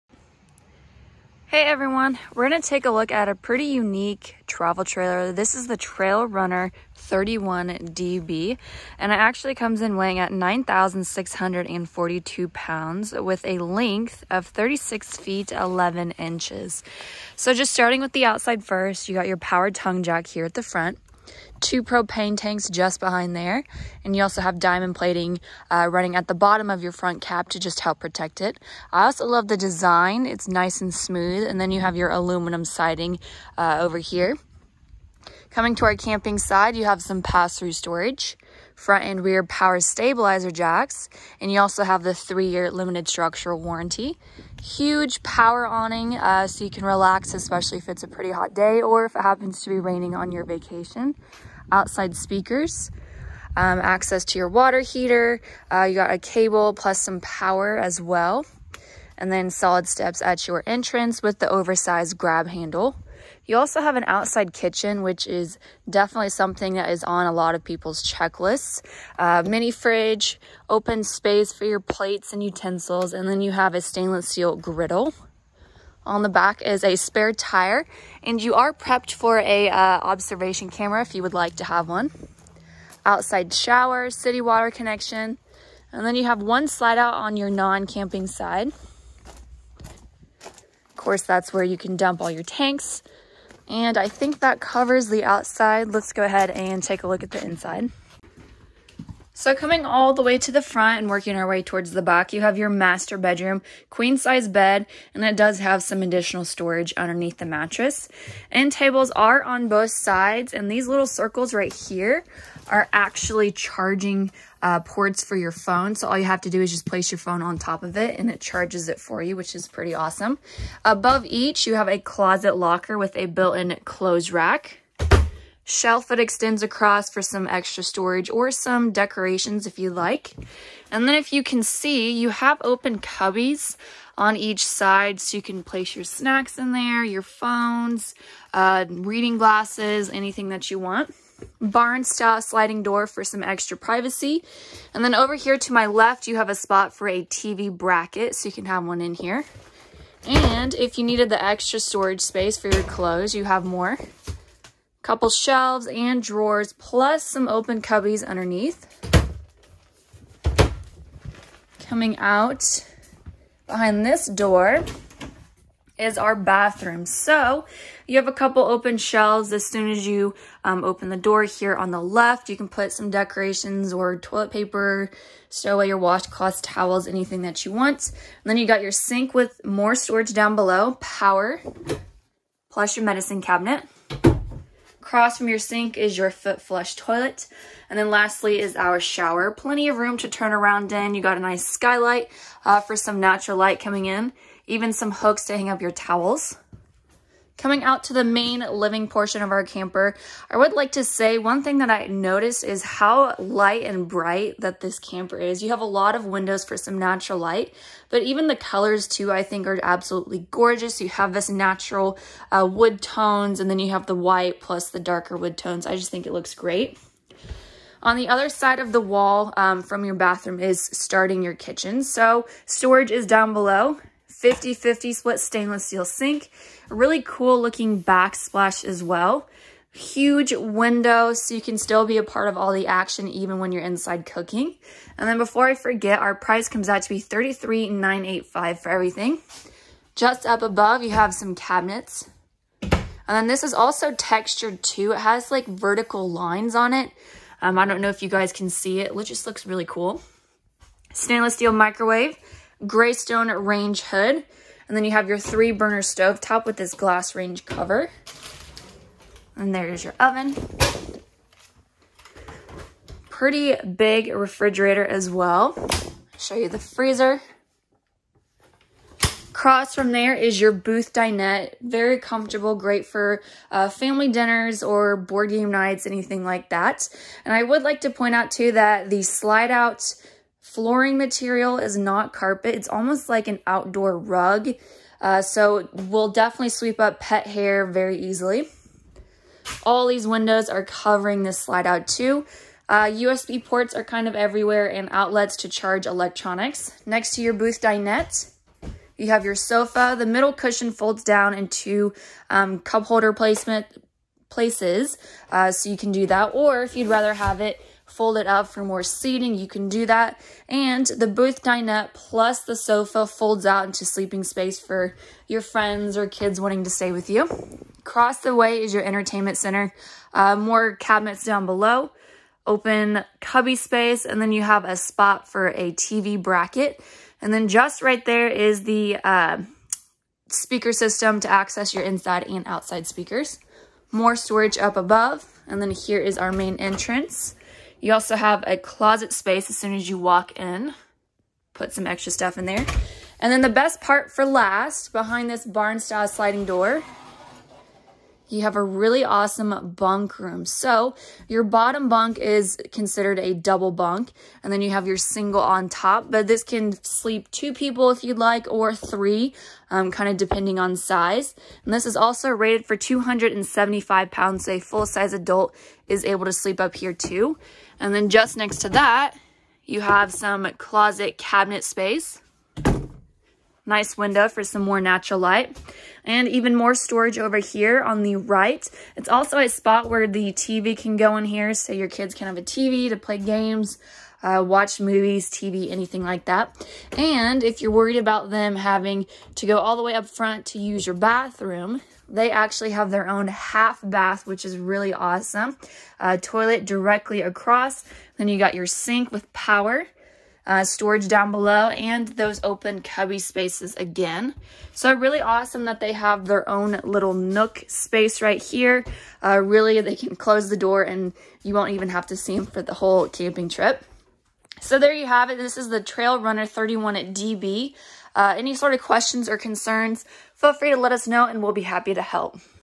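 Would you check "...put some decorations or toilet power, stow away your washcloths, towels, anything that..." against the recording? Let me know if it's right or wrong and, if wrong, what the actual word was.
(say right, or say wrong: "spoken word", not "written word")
wrong: "paper", not "power".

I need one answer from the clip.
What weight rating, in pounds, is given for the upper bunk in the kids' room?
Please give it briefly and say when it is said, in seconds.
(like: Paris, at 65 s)
275 pounds, at 362 s.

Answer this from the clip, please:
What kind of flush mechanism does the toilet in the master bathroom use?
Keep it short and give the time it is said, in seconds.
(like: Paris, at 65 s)
Foot flush, at 186 s.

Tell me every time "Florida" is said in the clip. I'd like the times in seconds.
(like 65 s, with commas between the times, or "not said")
not said.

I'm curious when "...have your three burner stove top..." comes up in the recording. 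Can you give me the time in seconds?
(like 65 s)
255 s.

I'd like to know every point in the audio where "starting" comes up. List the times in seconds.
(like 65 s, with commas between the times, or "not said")
17 s, 220 s.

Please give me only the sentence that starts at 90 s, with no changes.
Of course, that's where you can dump all your tanks, and I think that covers the outside.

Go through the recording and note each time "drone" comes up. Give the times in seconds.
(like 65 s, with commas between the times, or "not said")
not said.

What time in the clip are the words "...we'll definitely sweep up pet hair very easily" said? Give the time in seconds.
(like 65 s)
285 s.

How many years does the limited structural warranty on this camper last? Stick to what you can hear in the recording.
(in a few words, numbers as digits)
3 years.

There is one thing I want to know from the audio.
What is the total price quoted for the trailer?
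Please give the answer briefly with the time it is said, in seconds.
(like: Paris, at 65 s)
$33,985, at 237 s.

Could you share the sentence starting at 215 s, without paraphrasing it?
I just think it looks great.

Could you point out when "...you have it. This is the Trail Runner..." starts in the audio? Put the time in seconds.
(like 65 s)
415 s.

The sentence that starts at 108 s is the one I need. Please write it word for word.
End tables are on both sides, and these little circles right here are actually charging uh, ports for your phone.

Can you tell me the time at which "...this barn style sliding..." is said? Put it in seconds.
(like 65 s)
345 s.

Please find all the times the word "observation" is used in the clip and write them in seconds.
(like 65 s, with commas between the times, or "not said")
79 s.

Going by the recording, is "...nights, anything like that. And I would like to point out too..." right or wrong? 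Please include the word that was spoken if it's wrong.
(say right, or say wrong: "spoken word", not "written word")
right.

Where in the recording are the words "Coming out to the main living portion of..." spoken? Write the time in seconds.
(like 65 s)
197 s.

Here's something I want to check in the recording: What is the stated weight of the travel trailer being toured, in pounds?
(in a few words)
9,642 pounds.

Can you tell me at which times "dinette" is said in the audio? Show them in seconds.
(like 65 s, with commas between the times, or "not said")
271 s, 297 s, 311 s.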